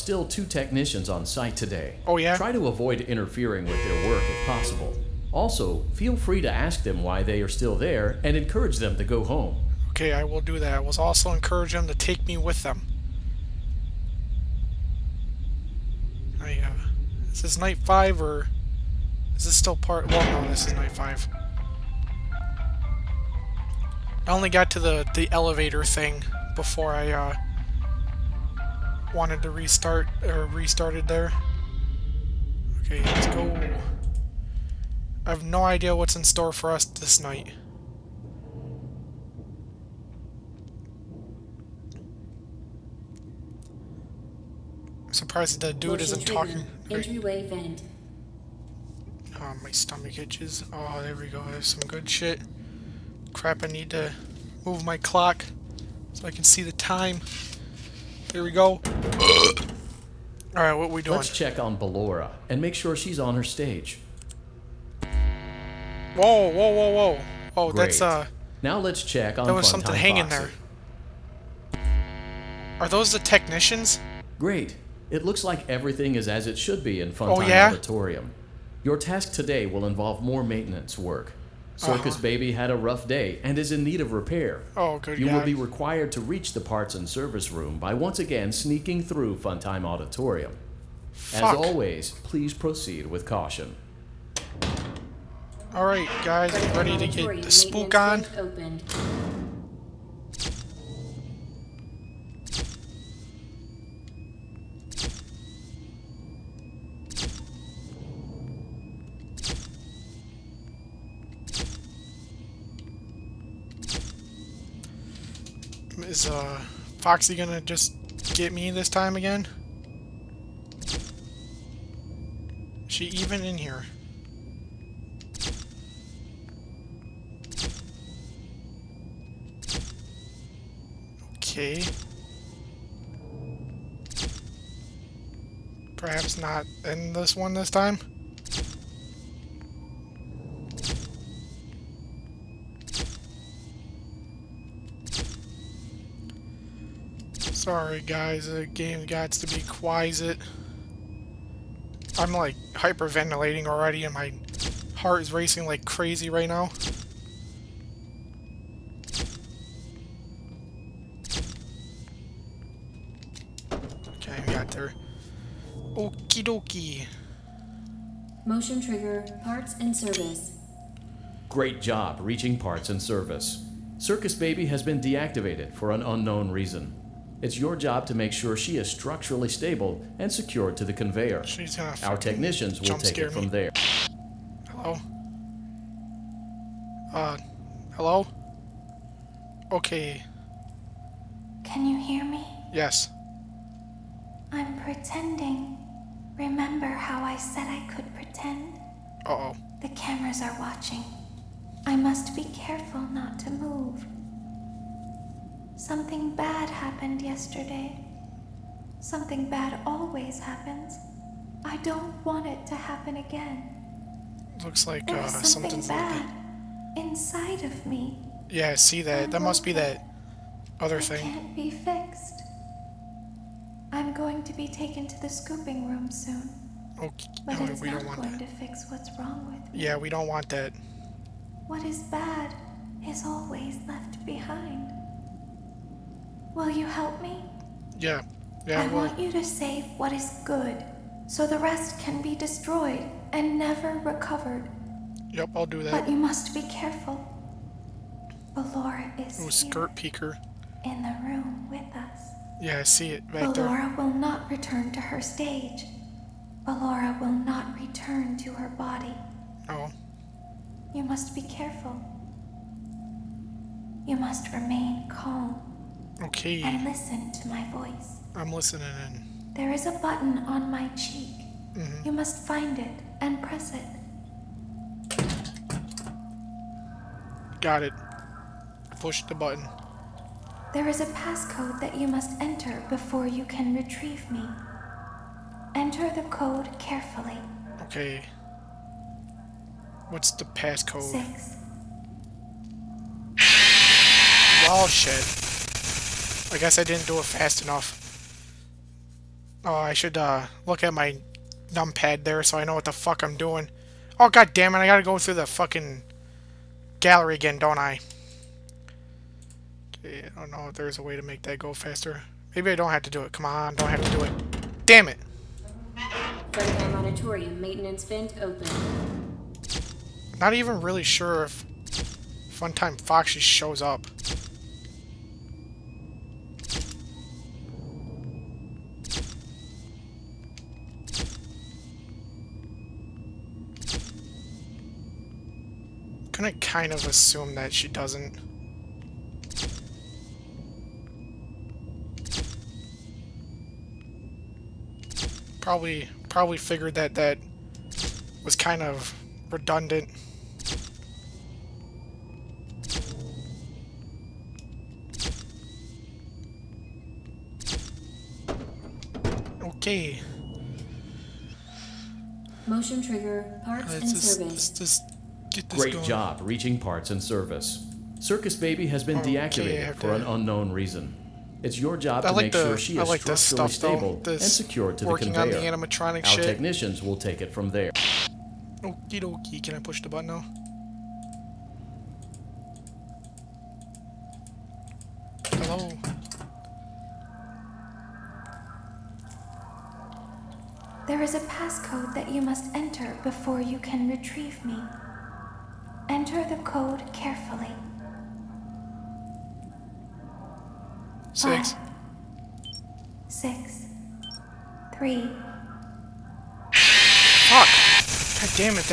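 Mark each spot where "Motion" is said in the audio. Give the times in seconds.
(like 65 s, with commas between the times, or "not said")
168 s, 362 s.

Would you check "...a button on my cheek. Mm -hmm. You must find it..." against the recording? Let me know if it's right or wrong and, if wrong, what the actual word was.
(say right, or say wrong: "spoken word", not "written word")
right.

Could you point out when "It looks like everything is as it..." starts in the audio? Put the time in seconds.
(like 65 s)
75 s.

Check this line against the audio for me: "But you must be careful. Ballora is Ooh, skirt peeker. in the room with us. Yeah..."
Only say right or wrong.
right.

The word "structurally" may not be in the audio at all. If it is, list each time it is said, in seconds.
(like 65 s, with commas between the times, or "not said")
178 s, 373 s.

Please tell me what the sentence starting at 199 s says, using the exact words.
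Uh oh The cameras are watching.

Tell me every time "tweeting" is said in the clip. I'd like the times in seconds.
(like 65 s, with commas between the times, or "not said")
not said.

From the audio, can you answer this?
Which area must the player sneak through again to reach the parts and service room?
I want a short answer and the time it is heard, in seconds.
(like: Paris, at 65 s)
Funtime Auditorium, at 89 s.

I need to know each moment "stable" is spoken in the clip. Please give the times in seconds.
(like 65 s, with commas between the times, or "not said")
179 s, 373 s.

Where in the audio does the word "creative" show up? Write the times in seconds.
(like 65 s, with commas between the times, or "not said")
not said.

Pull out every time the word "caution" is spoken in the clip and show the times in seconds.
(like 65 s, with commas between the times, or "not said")
93 s.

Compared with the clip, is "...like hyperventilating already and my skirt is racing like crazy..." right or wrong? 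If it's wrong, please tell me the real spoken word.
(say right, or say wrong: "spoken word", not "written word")
wrong: "heart", not "skirt".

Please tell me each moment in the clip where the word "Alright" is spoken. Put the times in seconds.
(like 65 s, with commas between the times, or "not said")
60 s, 95 s.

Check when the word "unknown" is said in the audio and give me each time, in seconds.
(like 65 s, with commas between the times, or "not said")
176 s, 370 s.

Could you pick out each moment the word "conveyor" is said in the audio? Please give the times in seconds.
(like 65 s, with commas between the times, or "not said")
180 s, 375 s.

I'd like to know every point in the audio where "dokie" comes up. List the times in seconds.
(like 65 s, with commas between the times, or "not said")
166 s, 379 s.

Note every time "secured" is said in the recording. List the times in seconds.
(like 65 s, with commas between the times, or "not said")
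180 s, 374 s.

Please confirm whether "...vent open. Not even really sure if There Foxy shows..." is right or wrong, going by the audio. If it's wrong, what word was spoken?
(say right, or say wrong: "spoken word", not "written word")
wrong: "Funtime", not "There".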